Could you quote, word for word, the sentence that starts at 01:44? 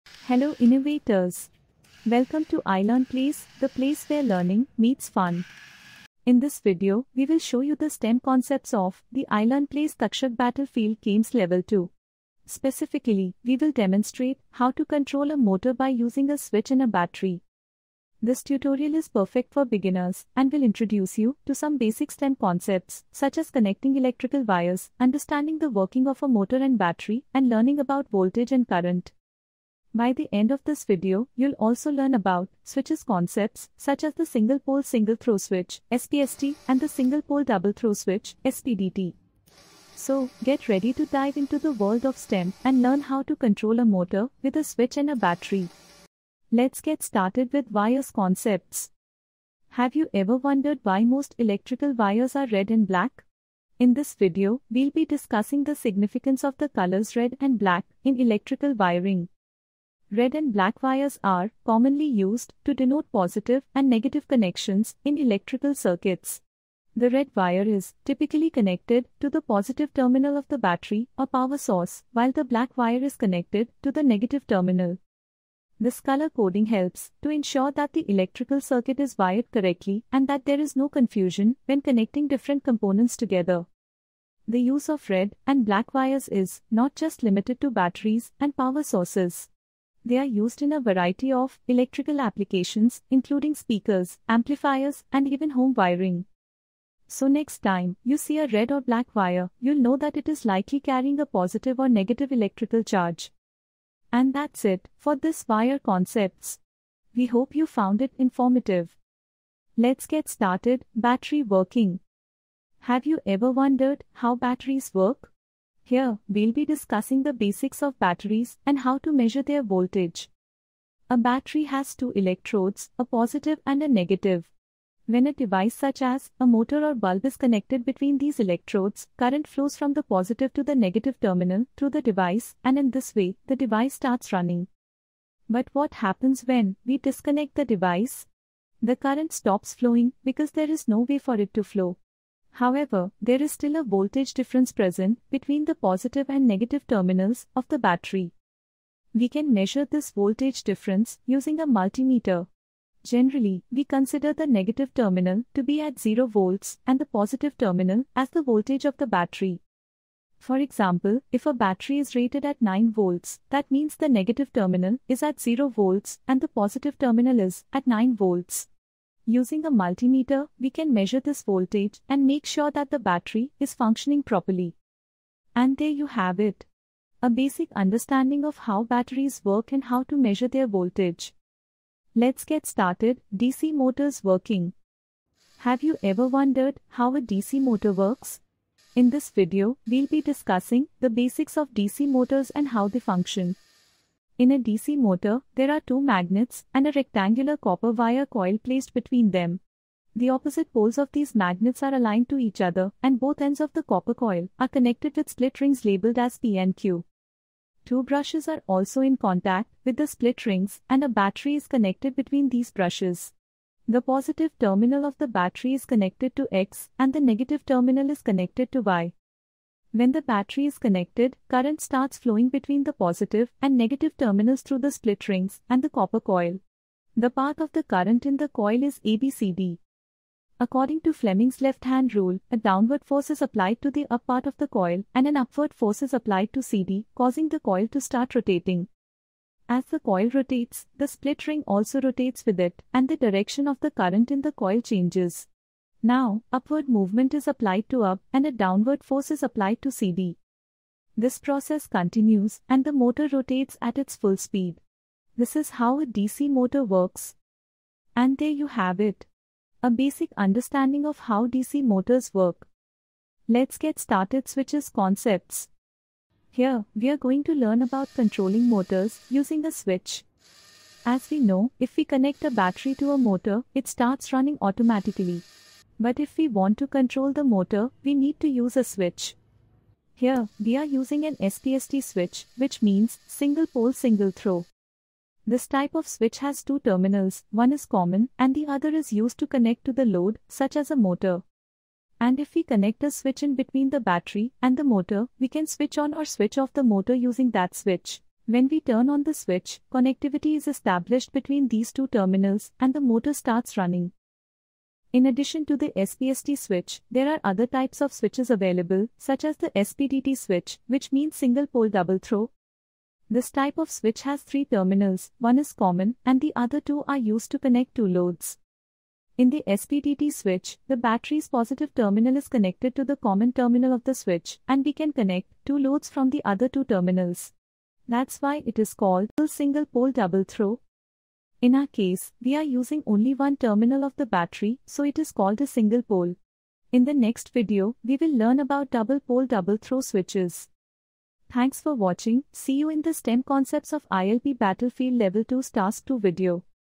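And that's it for this wire concepts.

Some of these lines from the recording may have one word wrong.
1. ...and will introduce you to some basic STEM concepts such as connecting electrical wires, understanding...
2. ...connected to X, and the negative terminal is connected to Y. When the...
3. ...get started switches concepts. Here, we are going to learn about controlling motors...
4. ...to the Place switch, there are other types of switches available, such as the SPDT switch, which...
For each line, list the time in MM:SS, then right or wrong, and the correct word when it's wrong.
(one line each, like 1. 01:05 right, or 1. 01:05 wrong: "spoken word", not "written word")
1. 00:20 right
2. 03:35 right
3. 04:23 right
4. 05:05 wrong: "SPST", not "Place".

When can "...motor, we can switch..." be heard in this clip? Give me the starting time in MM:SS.
04:54.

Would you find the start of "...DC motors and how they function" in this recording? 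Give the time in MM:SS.
03:11.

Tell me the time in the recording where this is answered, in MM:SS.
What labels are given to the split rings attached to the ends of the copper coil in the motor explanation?
03:26.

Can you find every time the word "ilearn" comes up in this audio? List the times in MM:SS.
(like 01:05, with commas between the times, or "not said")
00:02, 00:09.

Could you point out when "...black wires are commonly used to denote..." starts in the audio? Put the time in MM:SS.
01:00.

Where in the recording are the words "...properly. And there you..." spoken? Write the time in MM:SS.
02:54.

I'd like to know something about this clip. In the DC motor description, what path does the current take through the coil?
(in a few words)
ABCD.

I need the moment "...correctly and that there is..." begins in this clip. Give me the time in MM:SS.
01:19.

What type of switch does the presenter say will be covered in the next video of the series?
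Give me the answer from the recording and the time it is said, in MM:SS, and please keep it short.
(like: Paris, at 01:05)
double pole double throw, at 05:38.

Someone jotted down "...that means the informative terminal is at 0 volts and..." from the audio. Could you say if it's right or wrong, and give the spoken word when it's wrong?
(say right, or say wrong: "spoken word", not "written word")
wrong: "negative", not "informative".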